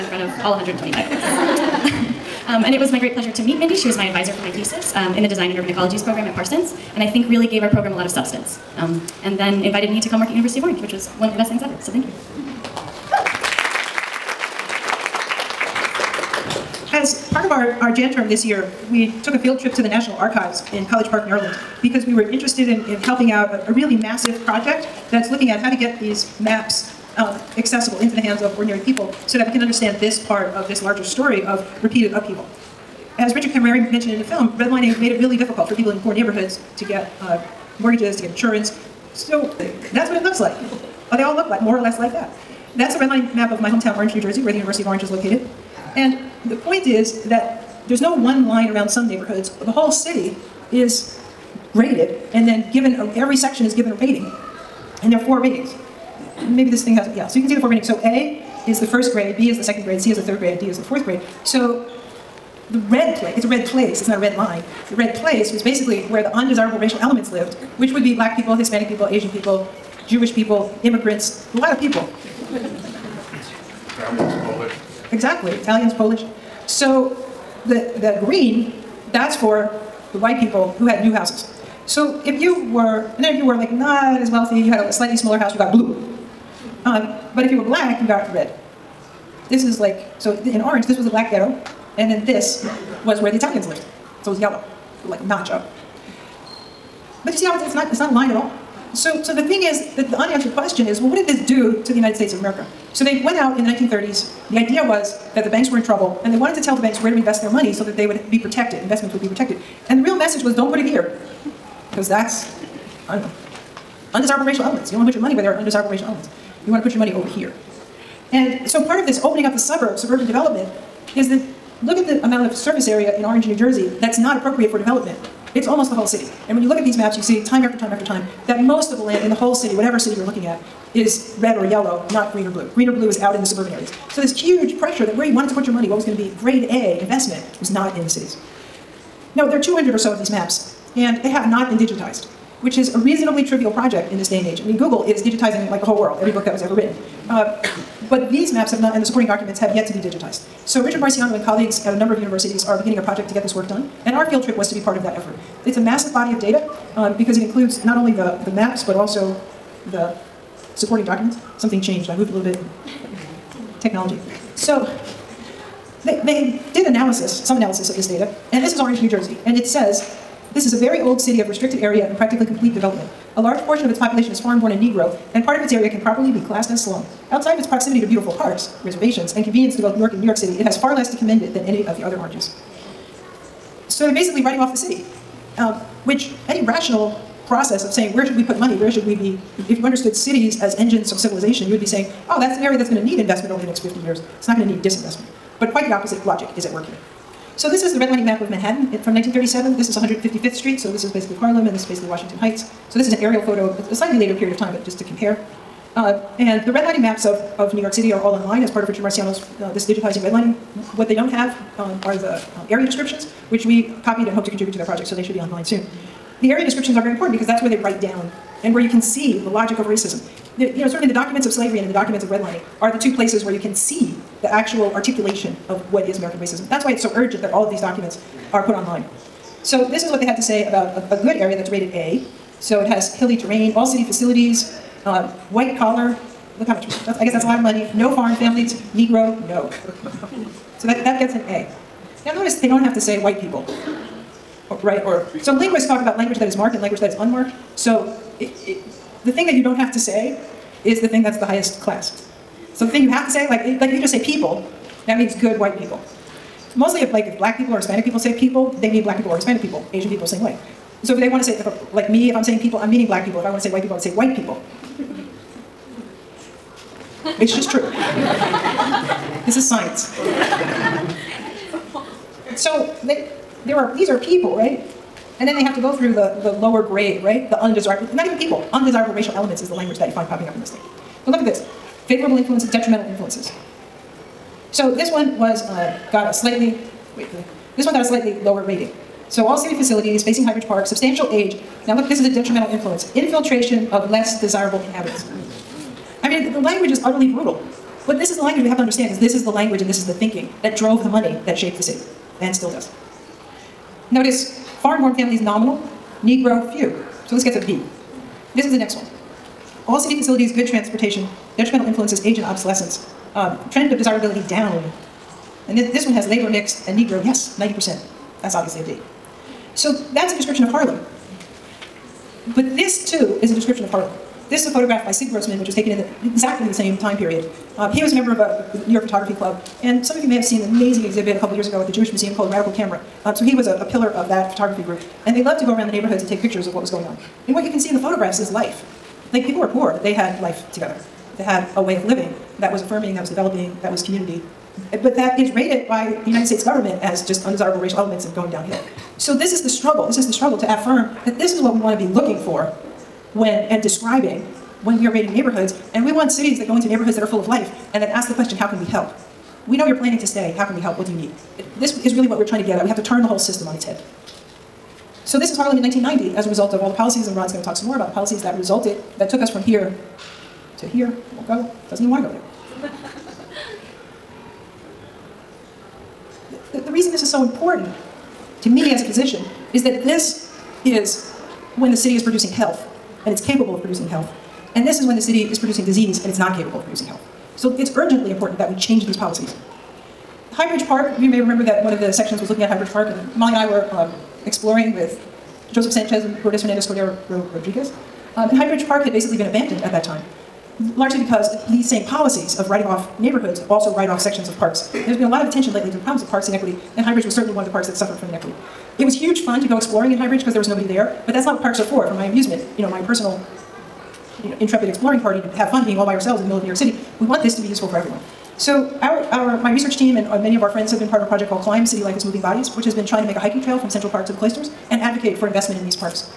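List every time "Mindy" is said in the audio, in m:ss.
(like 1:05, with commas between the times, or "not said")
0:03.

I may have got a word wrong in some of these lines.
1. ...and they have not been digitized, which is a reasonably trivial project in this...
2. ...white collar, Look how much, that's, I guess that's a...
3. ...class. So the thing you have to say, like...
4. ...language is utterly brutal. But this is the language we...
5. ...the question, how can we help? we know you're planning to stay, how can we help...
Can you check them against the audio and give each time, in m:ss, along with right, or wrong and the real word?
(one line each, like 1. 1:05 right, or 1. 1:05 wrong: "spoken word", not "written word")
1. 2:20 right
2. 3:55 right
3. 4:11 right
4. 4:56 right
5. 5:58 right.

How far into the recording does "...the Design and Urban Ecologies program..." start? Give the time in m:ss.
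0:05.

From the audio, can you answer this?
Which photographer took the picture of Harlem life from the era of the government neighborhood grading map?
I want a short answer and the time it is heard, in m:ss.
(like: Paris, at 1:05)
Sid Grossman, at 5:25.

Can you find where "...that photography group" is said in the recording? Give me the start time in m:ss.
5:34.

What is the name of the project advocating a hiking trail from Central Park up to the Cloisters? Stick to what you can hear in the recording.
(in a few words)
Climb.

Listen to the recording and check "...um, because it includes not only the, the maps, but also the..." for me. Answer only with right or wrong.
right.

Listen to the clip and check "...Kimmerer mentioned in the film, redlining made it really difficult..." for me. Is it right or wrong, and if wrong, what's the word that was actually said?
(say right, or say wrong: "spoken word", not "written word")
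right.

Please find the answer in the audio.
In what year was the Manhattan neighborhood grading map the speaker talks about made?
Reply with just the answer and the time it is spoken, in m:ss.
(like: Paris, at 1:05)
1937, at 3:19.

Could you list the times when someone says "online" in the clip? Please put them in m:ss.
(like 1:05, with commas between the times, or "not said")
3:28, 3:35, 3:48.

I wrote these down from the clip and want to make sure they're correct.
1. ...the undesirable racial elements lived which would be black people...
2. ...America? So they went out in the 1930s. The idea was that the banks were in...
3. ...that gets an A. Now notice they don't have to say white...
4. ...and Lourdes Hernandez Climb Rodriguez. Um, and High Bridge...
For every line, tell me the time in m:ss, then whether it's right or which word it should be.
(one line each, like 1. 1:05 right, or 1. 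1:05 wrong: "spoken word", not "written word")
1. 1:06 right
2. 1:42 right
3. 4:01 right
4. 6:36 wrong: "Cordero", not "Climb".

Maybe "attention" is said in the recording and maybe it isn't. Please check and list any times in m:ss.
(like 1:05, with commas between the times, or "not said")
6:45.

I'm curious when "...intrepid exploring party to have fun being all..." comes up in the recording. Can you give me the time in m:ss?
6:54.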